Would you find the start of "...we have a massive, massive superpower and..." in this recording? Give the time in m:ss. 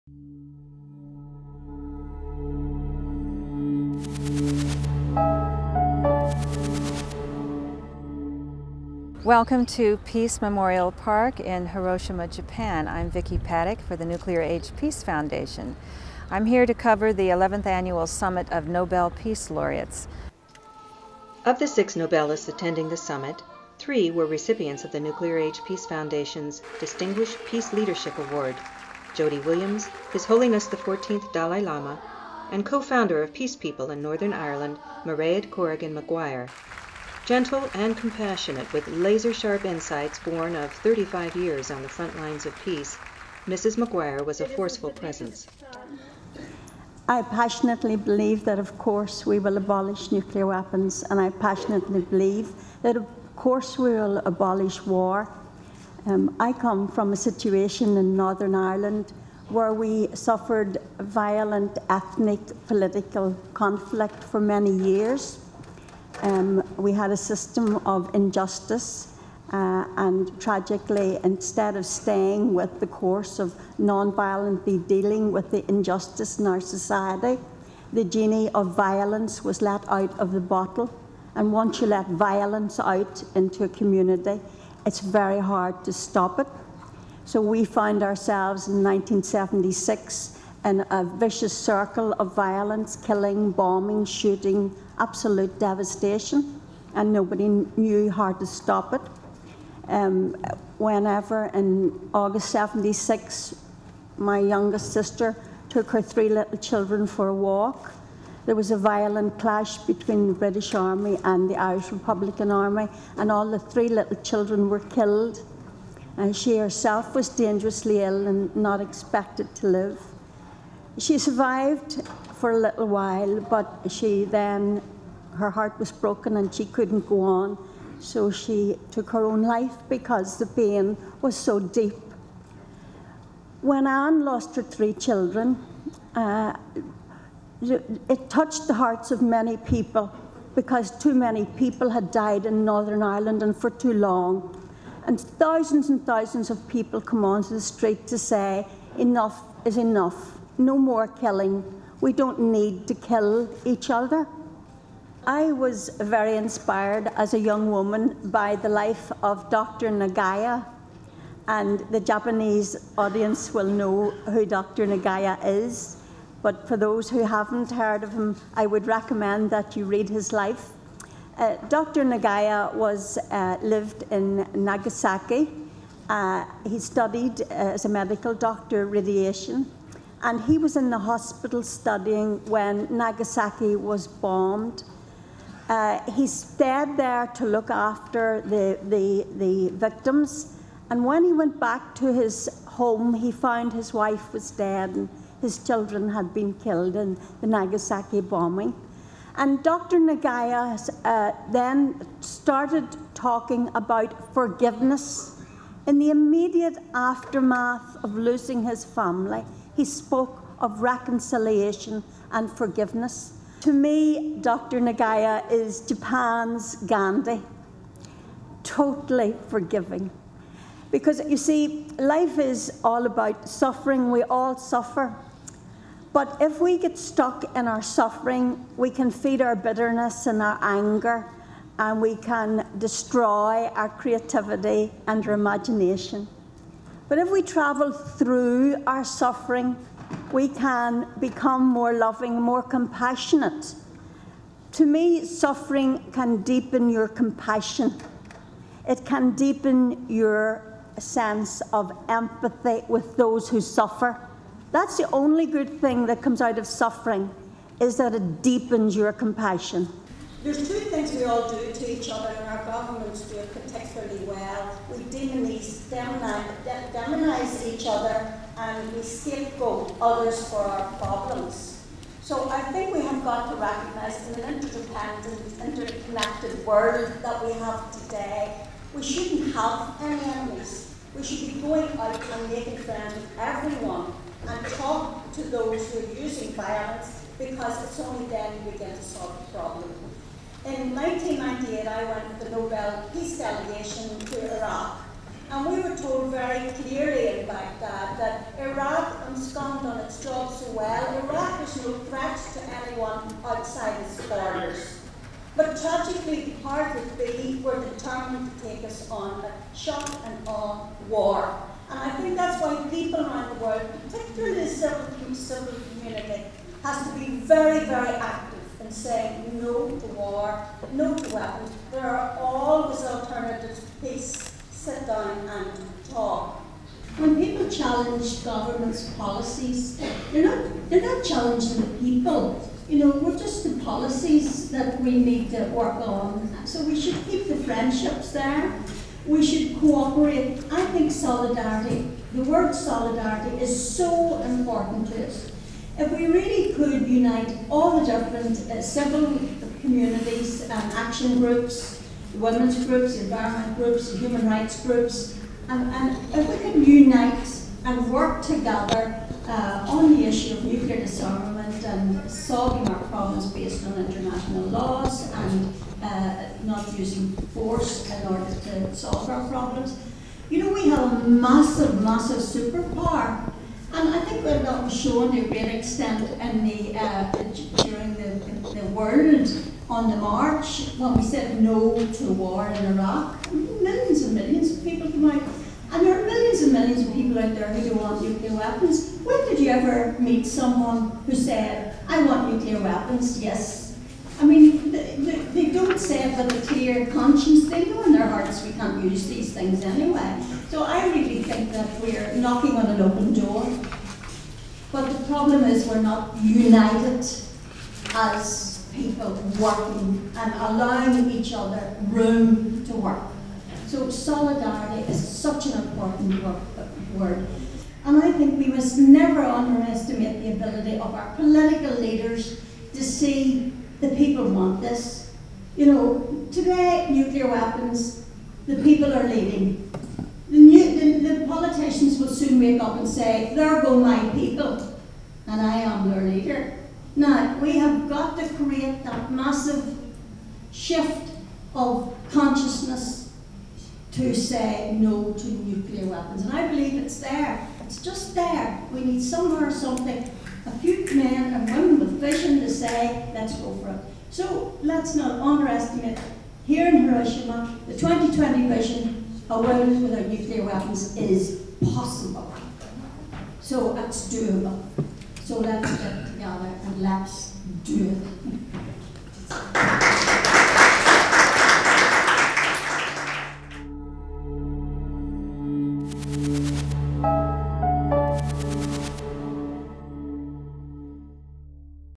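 6:10.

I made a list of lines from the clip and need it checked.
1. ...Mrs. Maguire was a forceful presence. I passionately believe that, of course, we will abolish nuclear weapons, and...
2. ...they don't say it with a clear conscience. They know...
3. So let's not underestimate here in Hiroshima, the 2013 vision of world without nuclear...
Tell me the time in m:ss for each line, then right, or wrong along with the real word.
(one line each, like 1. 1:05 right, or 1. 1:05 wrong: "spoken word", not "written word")
1. 0:43 right
2. 6:35 right
3. 7:34 wrong: "2020", not "2013".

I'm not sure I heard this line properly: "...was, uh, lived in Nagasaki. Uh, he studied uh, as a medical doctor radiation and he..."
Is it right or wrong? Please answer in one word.
right.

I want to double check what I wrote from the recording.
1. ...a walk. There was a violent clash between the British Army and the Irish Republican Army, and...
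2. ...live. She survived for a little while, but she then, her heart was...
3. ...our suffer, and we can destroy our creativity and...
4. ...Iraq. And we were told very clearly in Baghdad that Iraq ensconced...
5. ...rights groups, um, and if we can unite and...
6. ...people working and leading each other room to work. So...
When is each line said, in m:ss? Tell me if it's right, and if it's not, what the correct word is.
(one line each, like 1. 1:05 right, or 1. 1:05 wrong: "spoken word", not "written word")
1. 1:47 right
2. 1:59 right
3. 3:50 wrong: "anger", not "suffer"
4. 4:54 right
5. 5:54 right
6. 6:48 wrong: "allowing", not "leading".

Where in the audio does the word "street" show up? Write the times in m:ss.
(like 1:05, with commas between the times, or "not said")
2:27.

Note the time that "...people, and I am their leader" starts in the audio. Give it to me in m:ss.
7:14.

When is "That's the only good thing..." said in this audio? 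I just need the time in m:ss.
4:14.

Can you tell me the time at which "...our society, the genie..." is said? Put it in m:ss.
1:16.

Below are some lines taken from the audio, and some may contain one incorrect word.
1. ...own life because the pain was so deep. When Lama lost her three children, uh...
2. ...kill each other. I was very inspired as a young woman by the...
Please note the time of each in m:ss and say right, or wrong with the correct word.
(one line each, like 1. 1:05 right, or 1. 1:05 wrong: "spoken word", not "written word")
1. 2:09 wrong: "Anne", not "Lama"
2. 2:32 right.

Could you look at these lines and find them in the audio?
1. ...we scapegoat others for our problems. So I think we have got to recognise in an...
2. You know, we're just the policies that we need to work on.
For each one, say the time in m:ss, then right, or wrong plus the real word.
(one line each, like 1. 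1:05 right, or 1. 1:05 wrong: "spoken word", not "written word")
1. 4:28 right
2. 5:32 right.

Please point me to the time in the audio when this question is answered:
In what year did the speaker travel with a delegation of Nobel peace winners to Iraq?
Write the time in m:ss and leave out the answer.
4:50.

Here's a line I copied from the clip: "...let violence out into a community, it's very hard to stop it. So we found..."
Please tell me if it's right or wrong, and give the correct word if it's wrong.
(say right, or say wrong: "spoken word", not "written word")
right.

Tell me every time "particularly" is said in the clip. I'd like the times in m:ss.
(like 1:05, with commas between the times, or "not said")
4:23, 5:14.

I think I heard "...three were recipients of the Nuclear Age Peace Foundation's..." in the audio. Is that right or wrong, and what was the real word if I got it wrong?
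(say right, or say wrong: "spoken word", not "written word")
right.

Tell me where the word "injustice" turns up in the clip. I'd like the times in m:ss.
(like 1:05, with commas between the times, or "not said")
1:08, 1:15.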